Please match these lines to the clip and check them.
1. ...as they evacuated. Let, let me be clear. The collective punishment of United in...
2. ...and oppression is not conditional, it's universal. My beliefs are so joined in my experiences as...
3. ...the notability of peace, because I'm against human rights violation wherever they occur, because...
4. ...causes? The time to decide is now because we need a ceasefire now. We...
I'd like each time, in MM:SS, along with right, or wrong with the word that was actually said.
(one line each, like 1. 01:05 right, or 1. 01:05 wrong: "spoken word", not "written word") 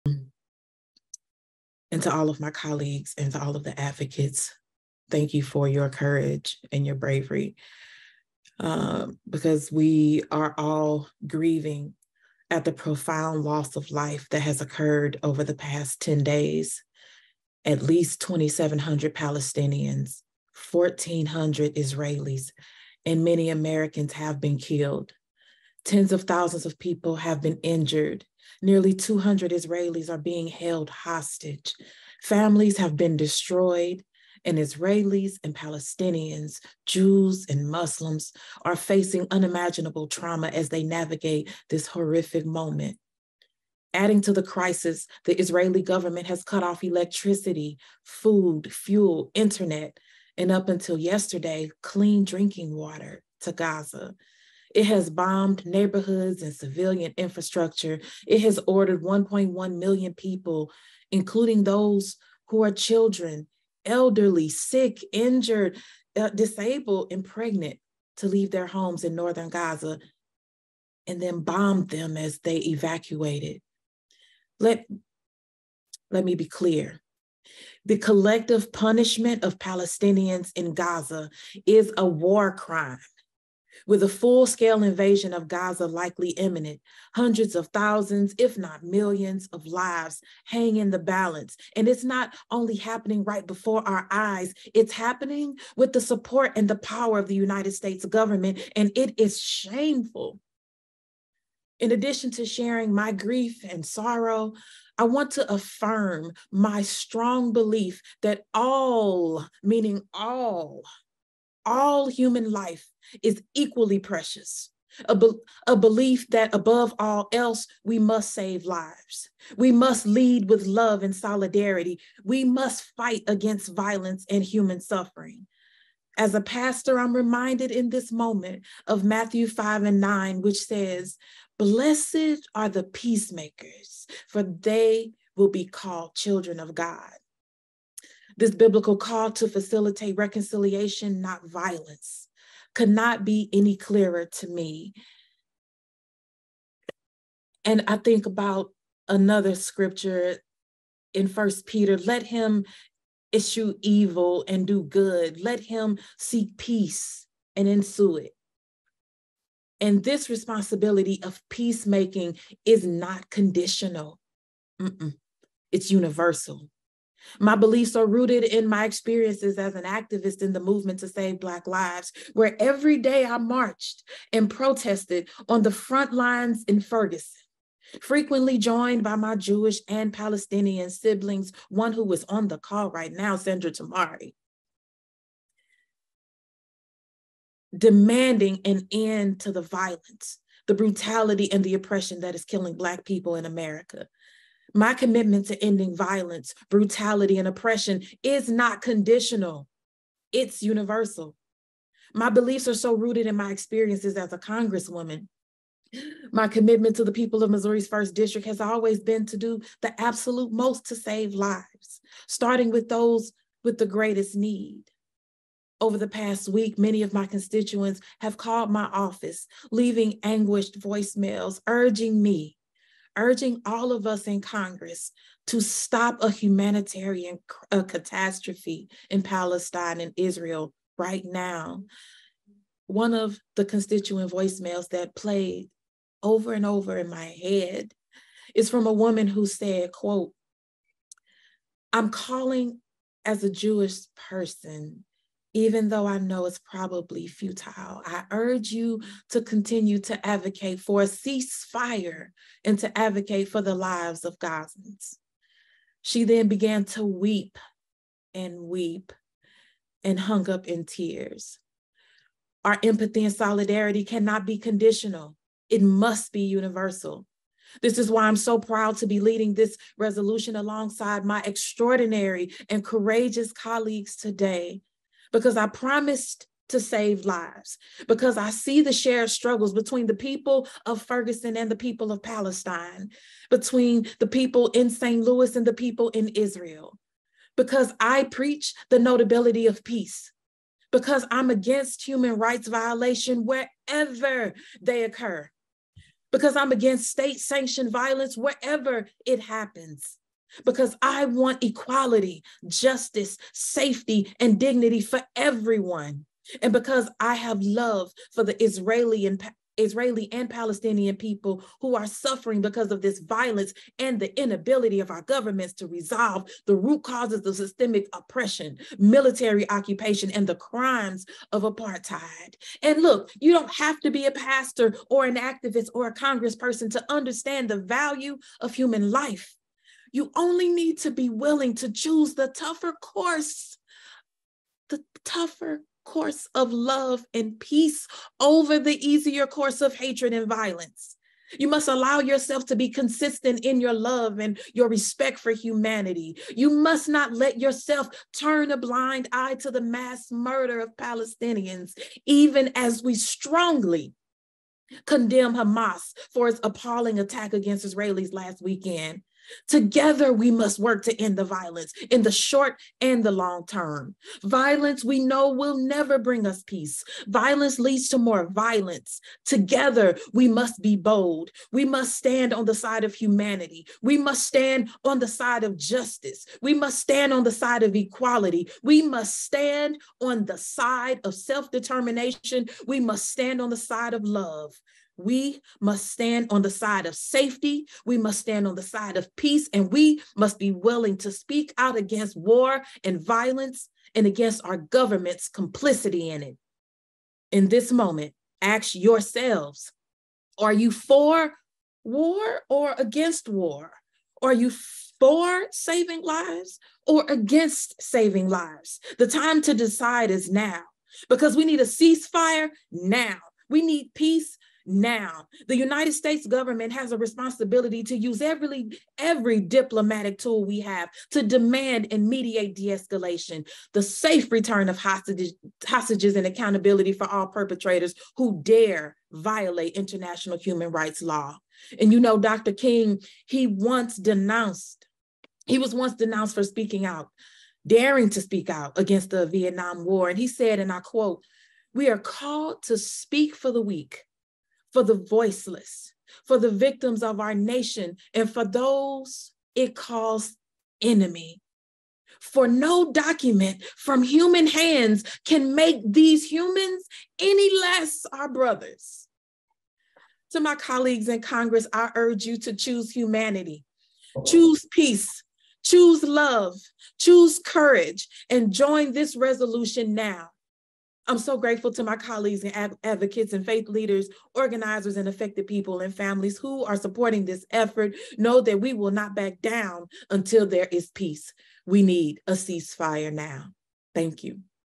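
1. 01:12 wrong: "Palestinians", not "United"
2. 03:17 wrong: "rooted", not "joined"
3. 04:48 right
4. 06:48 wrong: "lives", not "causes".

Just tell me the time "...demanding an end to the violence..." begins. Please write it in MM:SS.
03:07.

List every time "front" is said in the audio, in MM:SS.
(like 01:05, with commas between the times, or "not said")
02:55.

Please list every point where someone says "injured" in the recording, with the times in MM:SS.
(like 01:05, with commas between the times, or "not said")
00:27, 01:05.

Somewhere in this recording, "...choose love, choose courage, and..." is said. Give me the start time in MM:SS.
07:45.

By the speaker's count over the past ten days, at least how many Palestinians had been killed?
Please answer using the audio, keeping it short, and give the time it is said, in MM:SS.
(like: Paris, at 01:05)
2,700, at 00:18.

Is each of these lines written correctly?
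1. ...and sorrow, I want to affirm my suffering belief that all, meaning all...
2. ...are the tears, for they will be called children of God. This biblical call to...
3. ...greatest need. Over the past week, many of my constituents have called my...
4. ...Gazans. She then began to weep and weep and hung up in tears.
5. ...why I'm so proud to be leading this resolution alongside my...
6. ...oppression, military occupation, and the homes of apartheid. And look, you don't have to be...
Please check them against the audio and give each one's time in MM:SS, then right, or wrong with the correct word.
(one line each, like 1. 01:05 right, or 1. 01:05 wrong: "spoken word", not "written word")
1. 01:43 wrong: "strong", not "suffering"
2. 02:12 wrong: "peacemakers", not "tears"
3. 03:33 right
4. 04:14 right
5. 04:28 right
6. 05:18 wrong: "crimes", not "homes".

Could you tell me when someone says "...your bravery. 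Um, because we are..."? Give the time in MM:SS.
00:06.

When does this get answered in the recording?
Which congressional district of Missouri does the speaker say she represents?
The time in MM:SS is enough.
03:27.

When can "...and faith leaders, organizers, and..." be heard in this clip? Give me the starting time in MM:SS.
07:53.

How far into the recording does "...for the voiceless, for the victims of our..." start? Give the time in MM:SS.
07:24.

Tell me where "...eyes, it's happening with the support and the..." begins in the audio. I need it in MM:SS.
01:34.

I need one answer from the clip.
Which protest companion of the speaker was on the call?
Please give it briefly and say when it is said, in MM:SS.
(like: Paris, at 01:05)
Sandra Tamari, at 03:03.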